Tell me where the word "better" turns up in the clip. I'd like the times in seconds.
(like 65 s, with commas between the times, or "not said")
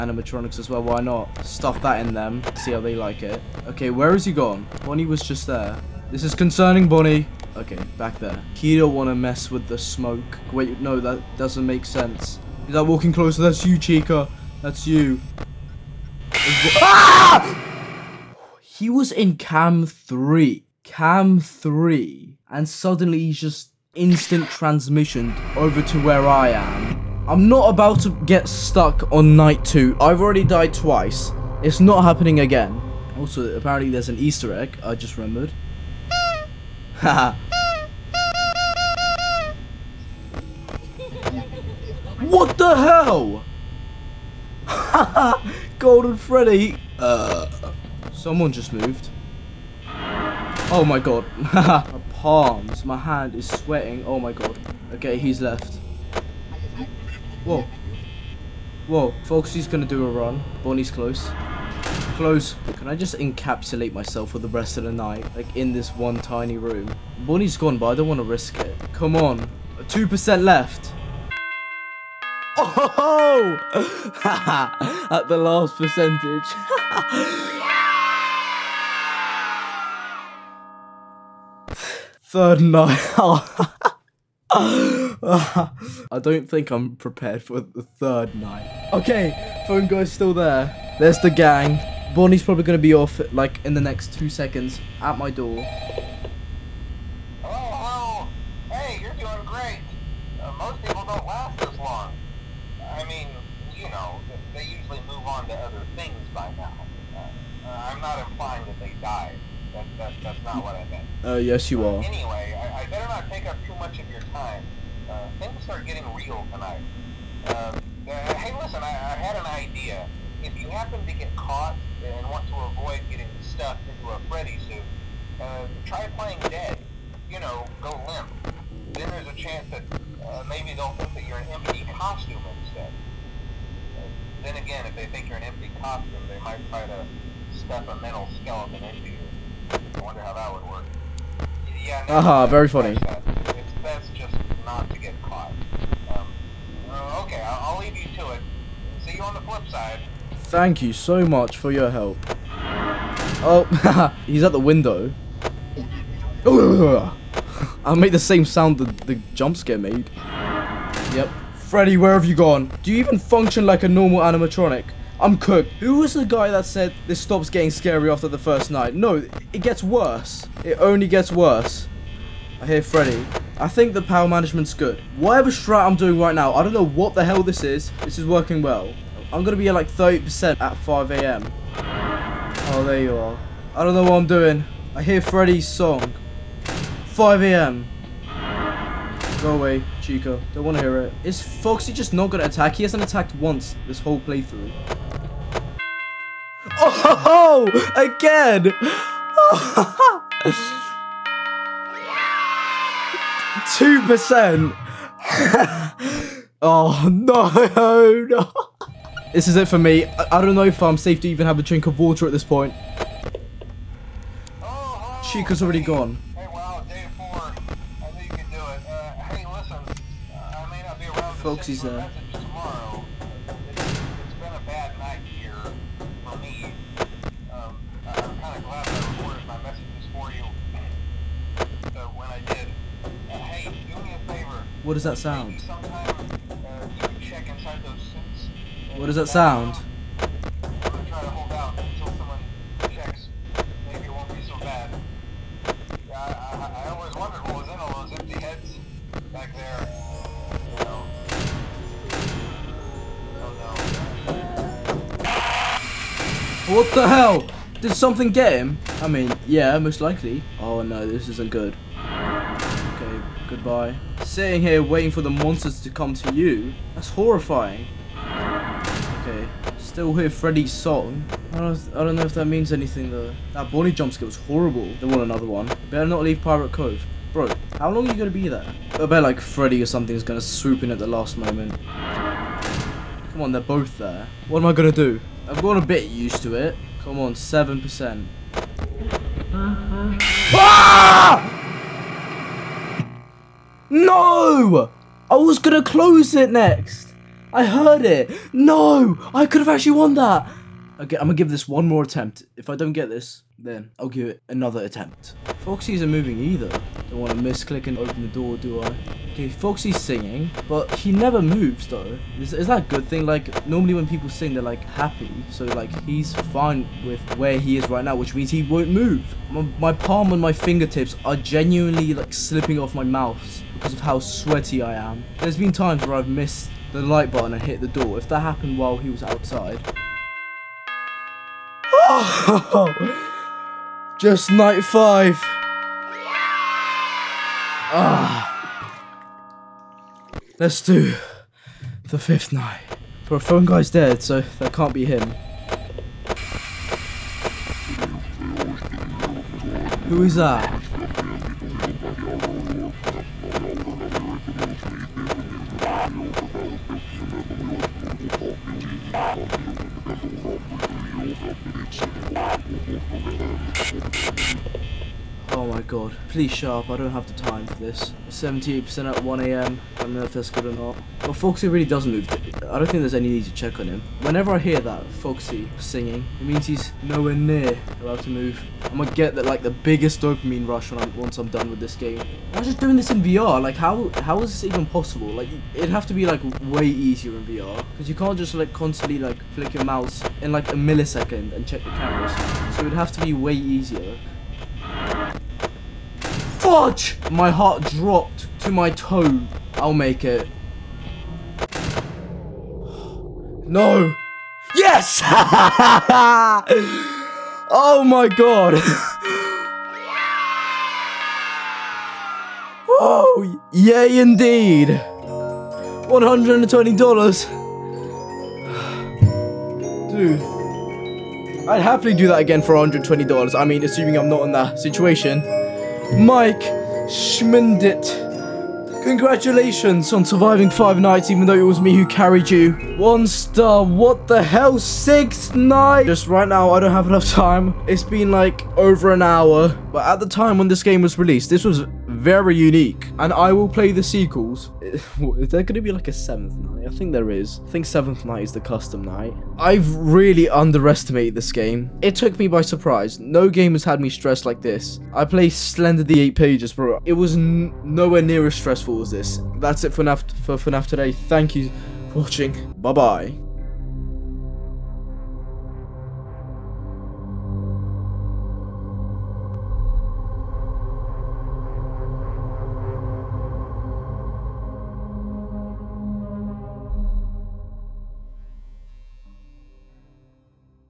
112 s, 275 s.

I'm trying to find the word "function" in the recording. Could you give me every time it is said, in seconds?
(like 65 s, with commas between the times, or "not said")
163 s.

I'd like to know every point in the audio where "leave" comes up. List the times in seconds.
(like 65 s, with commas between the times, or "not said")
147 s, 276 s.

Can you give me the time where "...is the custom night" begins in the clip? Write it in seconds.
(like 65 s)
448 s.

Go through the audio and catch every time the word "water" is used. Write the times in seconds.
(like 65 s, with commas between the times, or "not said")
211 s.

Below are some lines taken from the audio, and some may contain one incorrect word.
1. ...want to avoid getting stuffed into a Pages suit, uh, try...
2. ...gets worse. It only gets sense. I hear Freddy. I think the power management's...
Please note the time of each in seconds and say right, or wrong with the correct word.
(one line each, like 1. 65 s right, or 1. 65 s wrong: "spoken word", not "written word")
1. 122 s wrong: "Freddy", not "Pages"
2. 169 s wrong: "worse", not "sense".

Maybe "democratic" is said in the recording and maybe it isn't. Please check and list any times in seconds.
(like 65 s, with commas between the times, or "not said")
not said.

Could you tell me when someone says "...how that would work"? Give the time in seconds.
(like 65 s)
140 s.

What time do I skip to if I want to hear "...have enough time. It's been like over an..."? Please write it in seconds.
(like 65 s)
436 s.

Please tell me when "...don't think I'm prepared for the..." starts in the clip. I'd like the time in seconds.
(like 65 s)
86 s.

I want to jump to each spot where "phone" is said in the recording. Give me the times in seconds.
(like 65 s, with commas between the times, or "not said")
89 s, 343 s.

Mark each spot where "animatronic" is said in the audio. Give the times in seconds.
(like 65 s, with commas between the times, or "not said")
164 s.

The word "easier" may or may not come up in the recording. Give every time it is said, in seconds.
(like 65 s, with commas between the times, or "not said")
386 s, 393 s.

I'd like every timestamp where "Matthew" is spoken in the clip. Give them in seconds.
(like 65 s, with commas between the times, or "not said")
not said.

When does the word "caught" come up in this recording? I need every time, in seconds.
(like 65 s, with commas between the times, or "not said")
121 s, 145 s.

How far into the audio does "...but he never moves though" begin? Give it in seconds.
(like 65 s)
310 s.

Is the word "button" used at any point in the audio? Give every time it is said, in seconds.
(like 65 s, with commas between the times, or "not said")
327 s.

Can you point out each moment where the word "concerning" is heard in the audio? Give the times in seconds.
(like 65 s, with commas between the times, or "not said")
6 s.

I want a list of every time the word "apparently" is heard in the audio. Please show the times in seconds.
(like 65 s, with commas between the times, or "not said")
33 s.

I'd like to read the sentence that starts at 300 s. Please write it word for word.
Okay, I'm gonna give this one more attempt.